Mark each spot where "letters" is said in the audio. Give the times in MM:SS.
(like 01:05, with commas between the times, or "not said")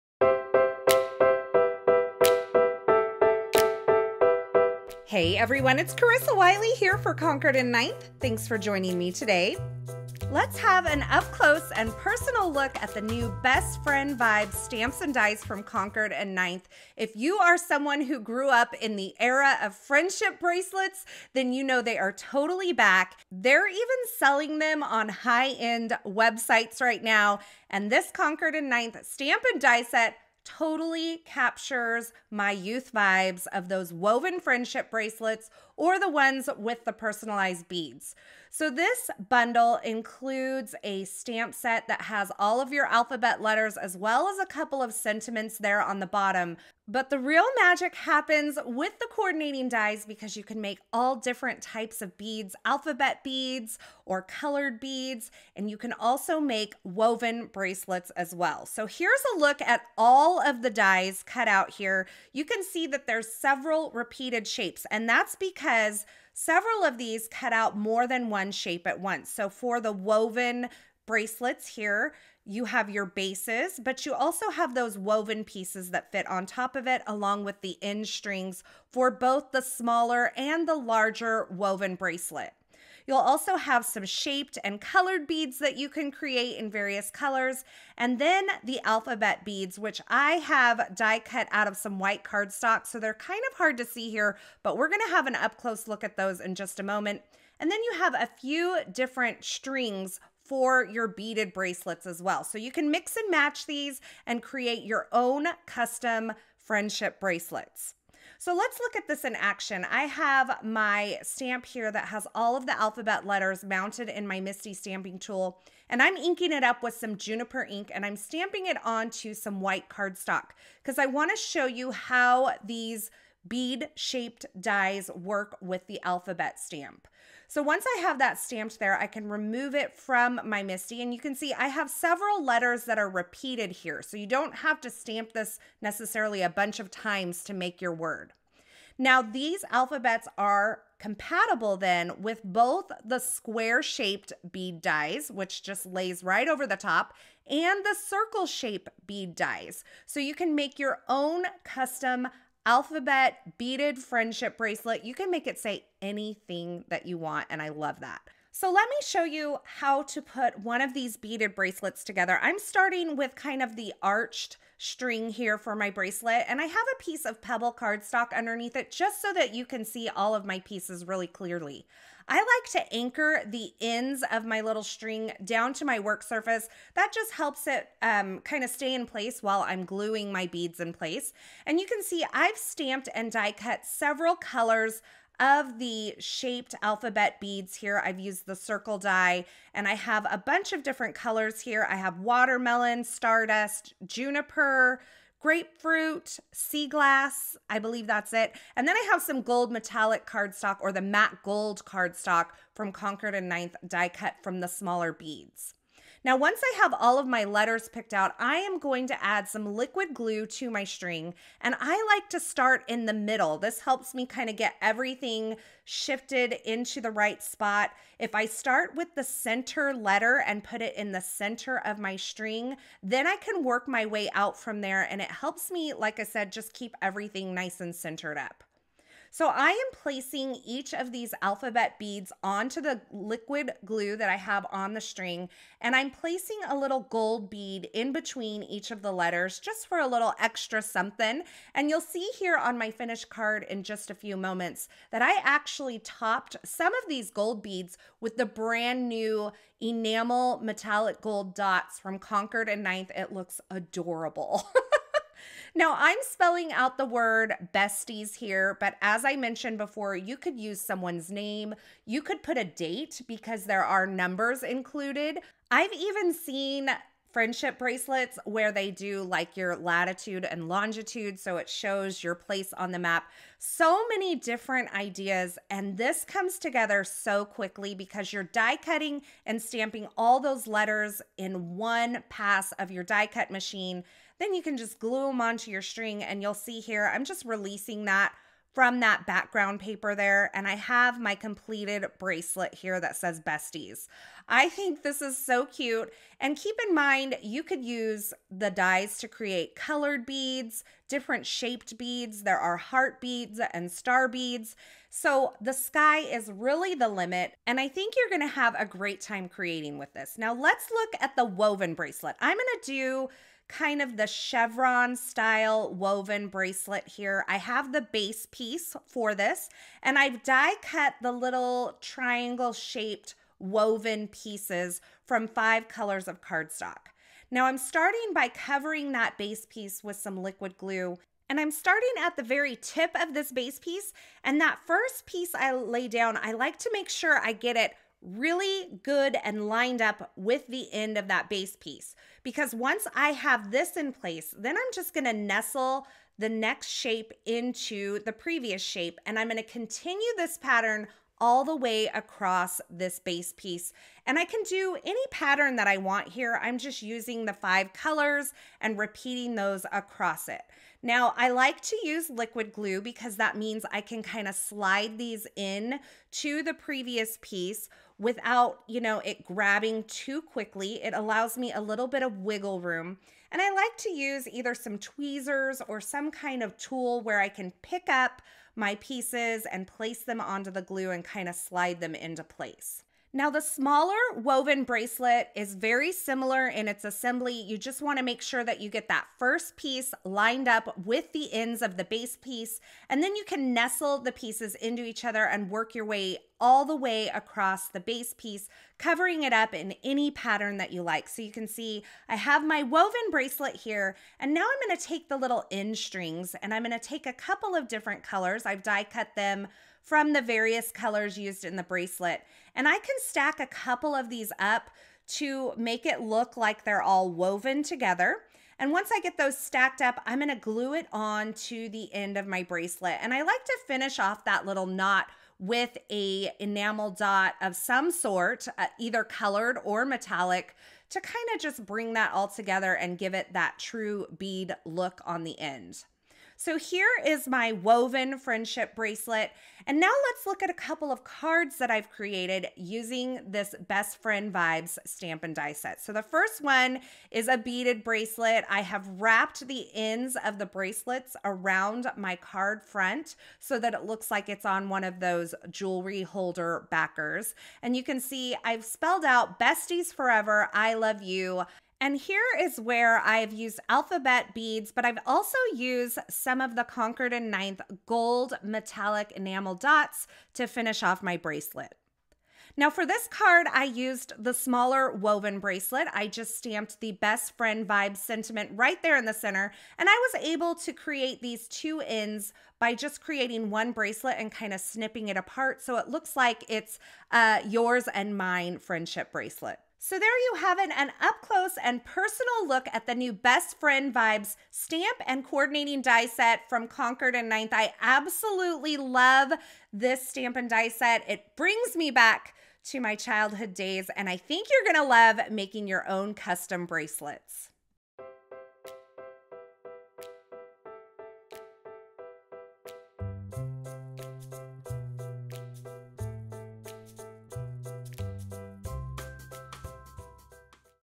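00:43, 01:53, 02:12, 03:27, 03:39, 03:59, 04:40.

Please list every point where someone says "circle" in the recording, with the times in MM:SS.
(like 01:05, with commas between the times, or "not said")
02:28, 03:08.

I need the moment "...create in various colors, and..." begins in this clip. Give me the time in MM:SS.
01:26.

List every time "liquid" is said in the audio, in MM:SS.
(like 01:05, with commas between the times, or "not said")
03:29, 03:53, 05:30, 06:02.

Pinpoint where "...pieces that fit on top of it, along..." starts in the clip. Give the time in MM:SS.
01:15.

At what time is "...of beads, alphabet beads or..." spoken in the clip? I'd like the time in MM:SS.
00:52.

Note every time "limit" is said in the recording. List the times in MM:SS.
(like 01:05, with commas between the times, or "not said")
05:07.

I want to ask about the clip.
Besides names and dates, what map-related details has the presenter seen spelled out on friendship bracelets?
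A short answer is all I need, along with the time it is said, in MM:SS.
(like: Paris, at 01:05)
Latitude and longitude, at 04:29.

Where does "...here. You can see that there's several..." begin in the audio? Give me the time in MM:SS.
01:01.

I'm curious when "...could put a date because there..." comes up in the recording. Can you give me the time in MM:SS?
04:22.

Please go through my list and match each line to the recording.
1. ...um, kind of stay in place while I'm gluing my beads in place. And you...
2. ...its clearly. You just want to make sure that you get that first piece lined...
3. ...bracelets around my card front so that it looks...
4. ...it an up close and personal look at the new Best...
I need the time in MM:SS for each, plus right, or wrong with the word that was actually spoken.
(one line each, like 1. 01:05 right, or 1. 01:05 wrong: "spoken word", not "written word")
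1. 02:58 right
2. 06:26 wrong: "assembly", not "clearly"
3. 07:30 right
4. 08:10 right.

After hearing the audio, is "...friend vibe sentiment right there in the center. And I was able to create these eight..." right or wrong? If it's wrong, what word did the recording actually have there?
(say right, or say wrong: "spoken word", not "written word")
wrong: "two", not "eight".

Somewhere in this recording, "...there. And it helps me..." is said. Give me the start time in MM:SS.
03:44.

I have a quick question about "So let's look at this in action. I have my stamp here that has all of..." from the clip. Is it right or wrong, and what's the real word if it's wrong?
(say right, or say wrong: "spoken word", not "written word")
right.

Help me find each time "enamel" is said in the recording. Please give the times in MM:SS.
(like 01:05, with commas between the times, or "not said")
04:09, 07:06, 07:49.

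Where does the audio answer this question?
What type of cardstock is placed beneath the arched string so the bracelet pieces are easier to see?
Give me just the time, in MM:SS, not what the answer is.
02:47.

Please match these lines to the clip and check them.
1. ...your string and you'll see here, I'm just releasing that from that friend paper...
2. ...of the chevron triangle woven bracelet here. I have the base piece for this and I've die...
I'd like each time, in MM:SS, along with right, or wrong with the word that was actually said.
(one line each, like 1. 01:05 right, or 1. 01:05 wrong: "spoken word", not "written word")
1. 04:45 wrong: "background", not "friend"
2. 05:14 wrong: "style", not "triangle".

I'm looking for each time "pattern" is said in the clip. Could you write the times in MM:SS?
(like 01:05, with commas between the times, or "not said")
05:50, 05:55, 06:40.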